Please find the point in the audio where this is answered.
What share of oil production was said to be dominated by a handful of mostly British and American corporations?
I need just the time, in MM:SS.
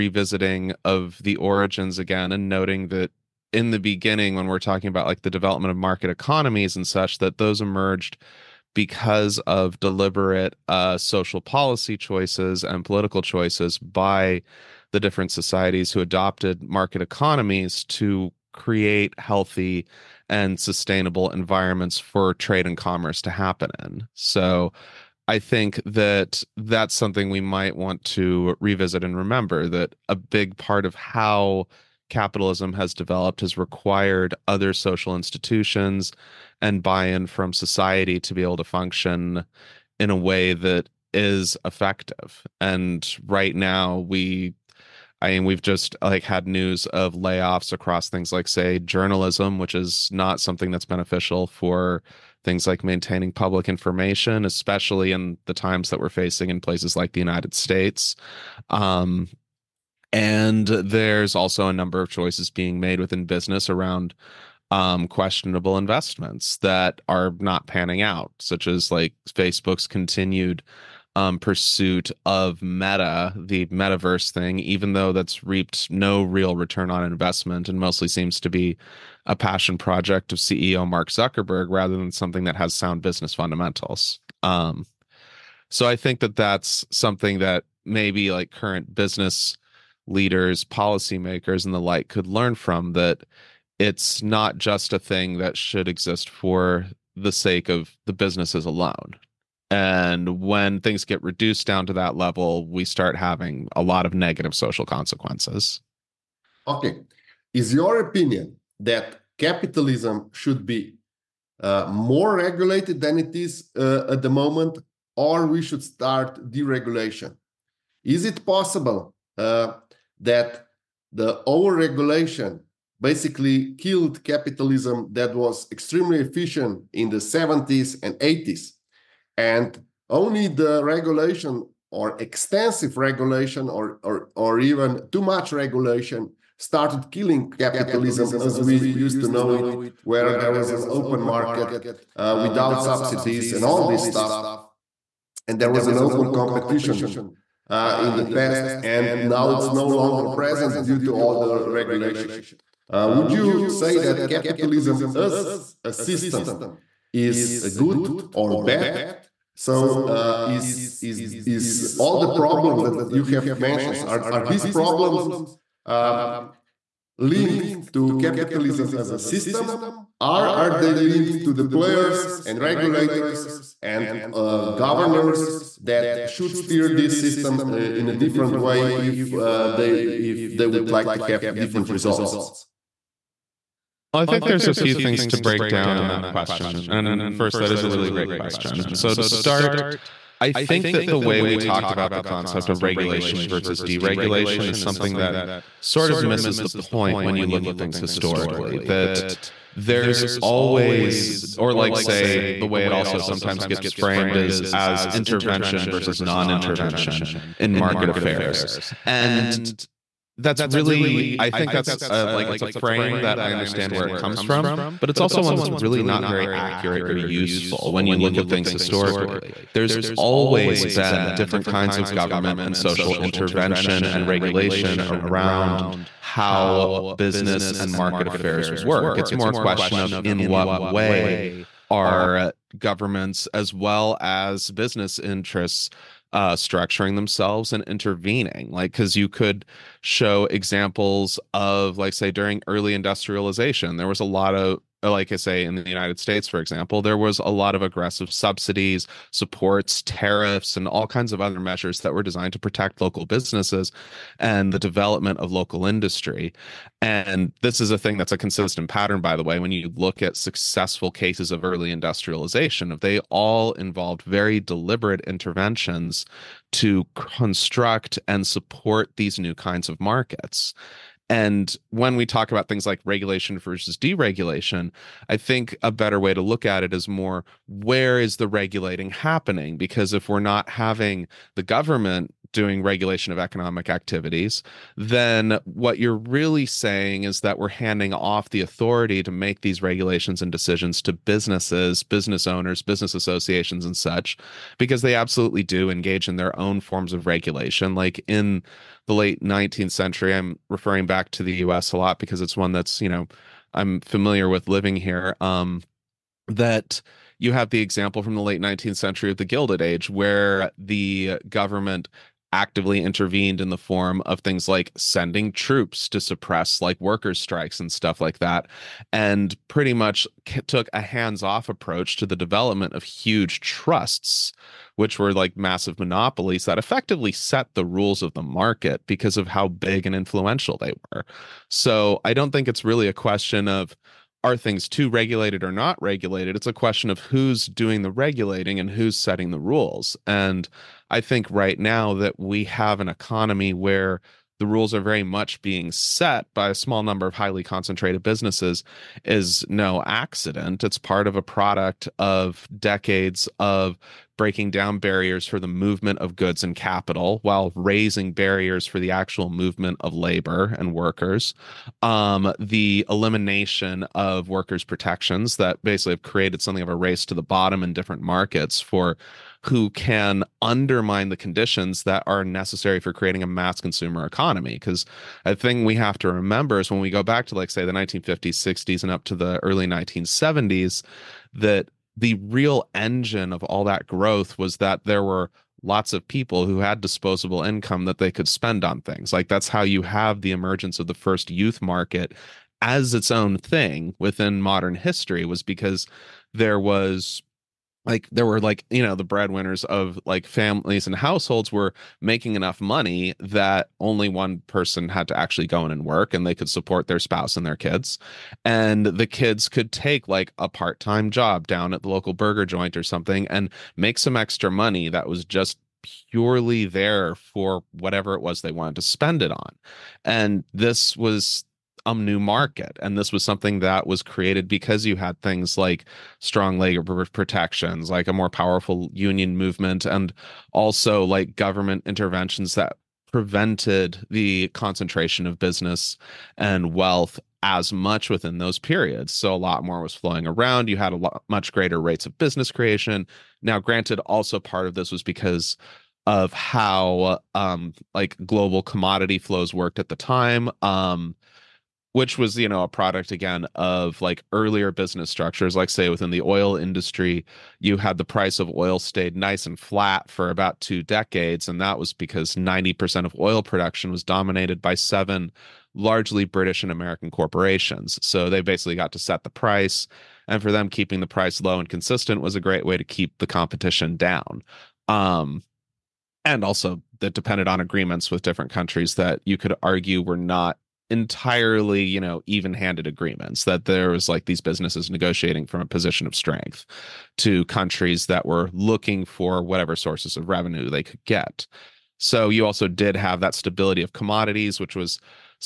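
07:42.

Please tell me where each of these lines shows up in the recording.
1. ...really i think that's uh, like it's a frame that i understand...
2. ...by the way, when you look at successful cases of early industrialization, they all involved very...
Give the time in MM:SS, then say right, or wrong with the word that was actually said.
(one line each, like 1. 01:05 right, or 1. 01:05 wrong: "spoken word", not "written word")
1. 03:30 right
2. 04:19 right.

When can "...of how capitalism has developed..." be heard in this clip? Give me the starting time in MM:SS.
00:30.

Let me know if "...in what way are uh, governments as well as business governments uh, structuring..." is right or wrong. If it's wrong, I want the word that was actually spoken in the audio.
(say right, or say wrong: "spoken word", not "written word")
wrong: "interests", not "governments".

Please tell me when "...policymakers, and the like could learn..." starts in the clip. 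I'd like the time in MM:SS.
01:30.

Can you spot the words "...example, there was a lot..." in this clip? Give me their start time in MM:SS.
04:06.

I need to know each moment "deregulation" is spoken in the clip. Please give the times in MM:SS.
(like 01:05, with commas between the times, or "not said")
01:56, 03:13, 04:33.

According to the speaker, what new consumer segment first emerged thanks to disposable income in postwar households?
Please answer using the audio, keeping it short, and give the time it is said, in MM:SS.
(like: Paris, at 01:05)
Youth market, at 06:31.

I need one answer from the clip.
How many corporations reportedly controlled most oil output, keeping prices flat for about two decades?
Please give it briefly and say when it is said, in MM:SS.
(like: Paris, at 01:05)
7, at 07:44.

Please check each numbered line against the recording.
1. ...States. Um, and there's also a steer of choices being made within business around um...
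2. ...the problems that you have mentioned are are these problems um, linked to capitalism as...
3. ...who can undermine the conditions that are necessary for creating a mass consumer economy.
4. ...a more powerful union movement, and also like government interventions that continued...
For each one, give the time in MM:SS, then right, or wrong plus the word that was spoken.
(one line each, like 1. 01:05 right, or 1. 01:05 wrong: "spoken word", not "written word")
1. 00:57 wrong: "number", not "steer"
2. 02:42 right
3. 06:09 right
4. 07:08 wrong: "prevented", not "continued".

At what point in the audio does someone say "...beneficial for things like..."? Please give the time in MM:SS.
00:50.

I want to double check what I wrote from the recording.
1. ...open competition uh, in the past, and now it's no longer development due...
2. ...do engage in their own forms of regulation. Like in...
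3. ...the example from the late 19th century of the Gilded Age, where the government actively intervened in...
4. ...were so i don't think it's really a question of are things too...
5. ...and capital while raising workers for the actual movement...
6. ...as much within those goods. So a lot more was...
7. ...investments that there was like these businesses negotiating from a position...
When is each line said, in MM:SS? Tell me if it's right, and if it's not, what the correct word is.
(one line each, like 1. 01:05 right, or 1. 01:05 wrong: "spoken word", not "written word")
1. 02:25 wrong: "present", not "development"
2. 04:55 right
3. 05:07 right
4. 05:31 right
5. 05:56 wrong: "barriers", not "workers"
6. 07:17 wrong: "periods", not "goods"
7. 08:03 wrong: "agreements", not "investments".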